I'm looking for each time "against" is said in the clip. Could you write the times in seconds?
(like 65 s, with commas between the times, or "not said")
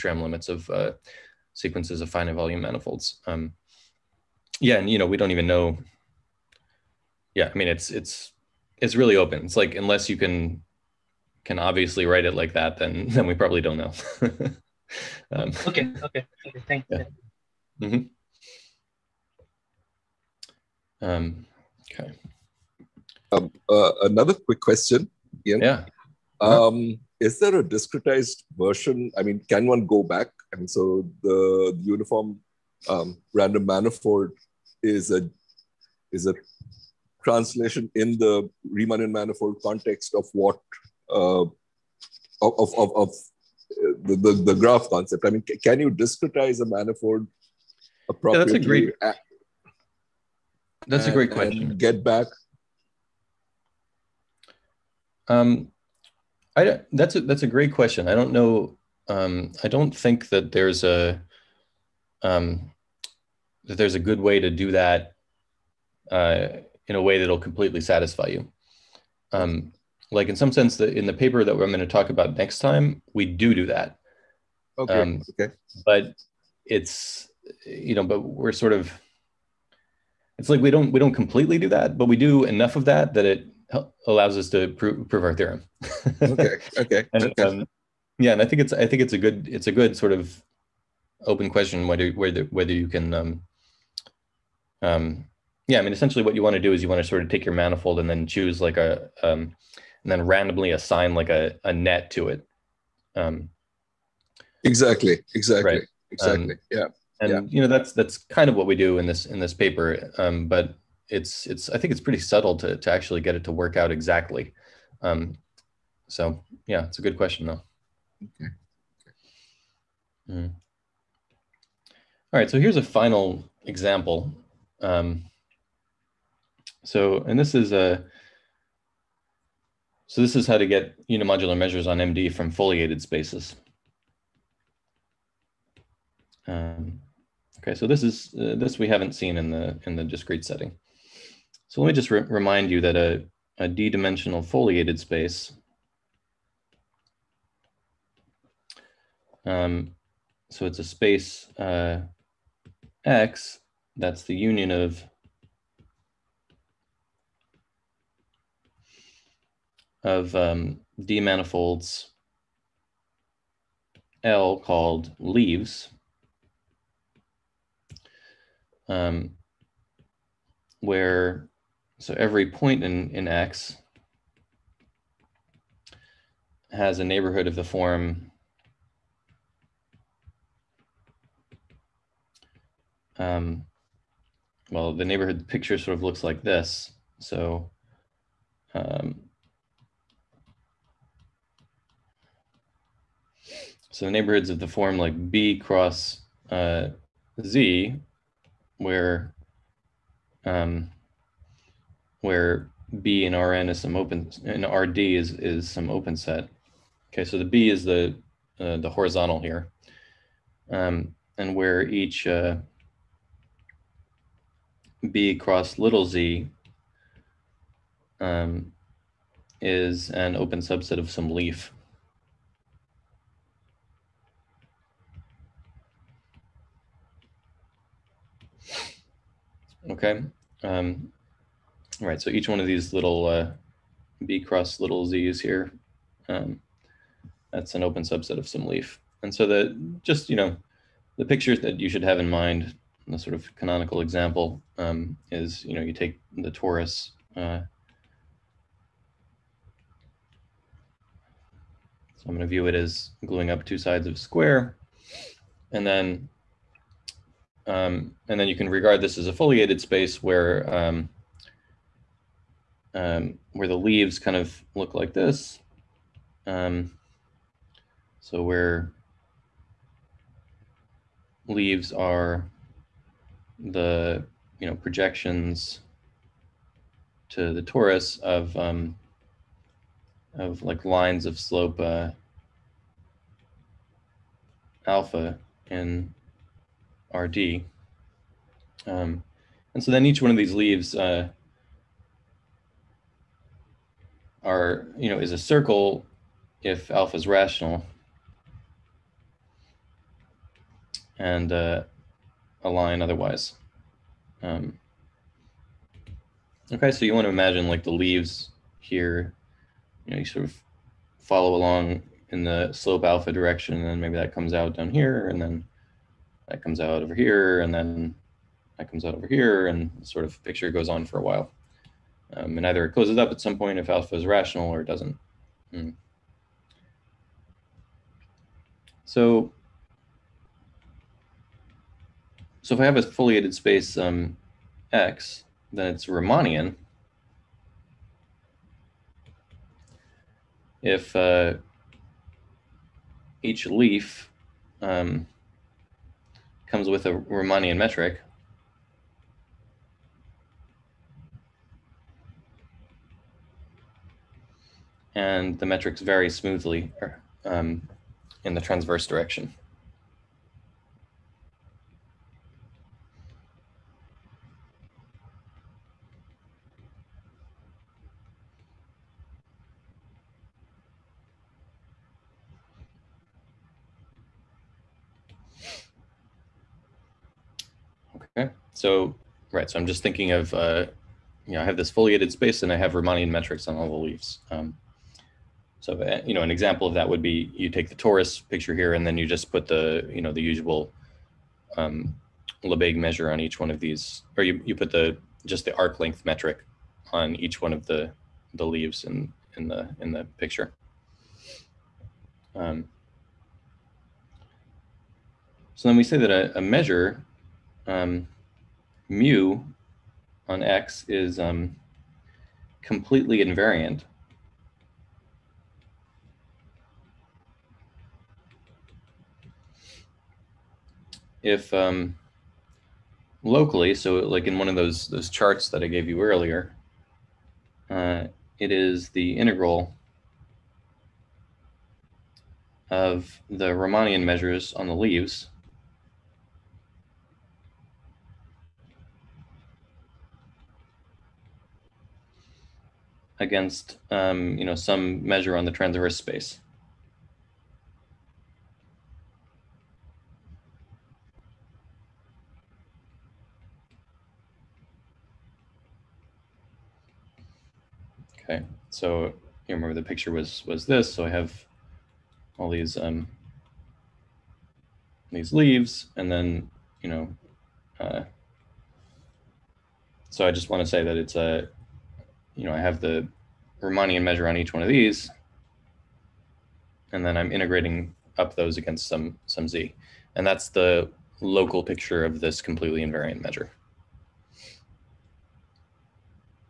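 443 s, 478 s.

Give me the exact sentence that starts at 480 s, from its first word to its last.
And that's the local picture of this completely invariant measure.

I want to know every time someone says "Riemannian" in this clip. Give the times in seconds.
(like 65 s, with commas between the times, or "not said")
38 s, 336 s, 347 s, 382 s, 433 s, 473 s.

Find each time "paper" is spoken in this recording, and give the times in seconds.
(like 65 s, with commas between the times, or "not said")
71 s, 109 s.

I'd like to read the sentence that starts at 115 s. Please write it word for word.
Um, so yeah, it's a good question though.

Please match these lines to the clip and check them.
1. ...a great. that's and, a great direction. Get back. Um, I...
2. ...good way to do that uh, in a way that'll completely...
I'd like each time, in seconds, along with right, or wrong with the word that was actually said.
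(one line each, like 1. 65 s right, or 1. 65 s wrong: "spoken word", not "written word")
1. 48 s wrong: "question", not "direction"
2. 63 s right.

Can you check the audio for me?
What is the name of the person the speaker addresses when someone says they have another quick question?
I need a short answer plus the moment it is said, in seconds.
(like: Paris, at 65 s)
Ian, at 25 s.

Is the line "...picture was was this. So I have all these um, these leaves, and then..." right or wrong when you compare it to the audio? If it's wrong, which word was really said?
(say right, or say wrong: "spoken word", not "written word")
right.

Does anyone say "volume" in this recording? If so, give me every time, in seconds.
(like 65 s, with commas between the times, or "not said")
2 s.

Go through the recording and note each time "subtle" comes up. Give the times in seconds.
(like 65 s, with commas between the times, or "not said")
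112 s.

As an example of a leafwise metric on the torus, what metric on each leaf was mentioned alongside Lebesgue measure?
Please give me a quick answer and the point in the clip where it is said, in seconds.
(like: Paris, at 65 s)
arc length metric, at 395 s.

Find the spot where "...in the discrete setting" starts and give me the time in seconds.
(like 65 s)
139 s.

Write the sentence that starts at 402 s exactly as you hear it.
Um, so then we say that a, a measure um, mu on X is um, completely invariant.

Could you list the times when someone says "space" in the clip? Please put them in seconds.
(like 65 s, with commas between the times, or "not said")
133 s, 145 s, 150 s, 259 s, 333 s, 382 s, 446 s.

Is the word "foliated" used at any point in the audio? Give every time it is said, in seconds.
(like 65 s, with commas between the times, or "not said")
132 s, 144 s, 259 s, 333 s, 381 s.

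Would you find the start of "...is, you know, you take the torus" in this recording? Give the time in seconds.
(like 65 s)
245 s.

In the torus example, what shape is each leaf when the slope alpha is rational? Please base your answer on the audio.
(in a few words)
a circle.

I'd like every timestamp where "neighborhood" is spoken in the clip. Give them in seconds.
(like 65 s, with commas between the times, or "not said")
177 s, 185 s, 194 s.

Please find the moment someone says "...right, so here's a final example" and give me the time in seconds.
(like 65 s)
122 s.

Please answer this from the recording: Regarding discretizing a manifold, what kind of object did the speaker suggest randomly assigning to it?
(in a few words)
a net.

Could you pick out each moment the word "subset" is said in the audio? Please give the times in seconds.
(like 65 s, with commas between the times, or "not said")
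220 s, 238 s.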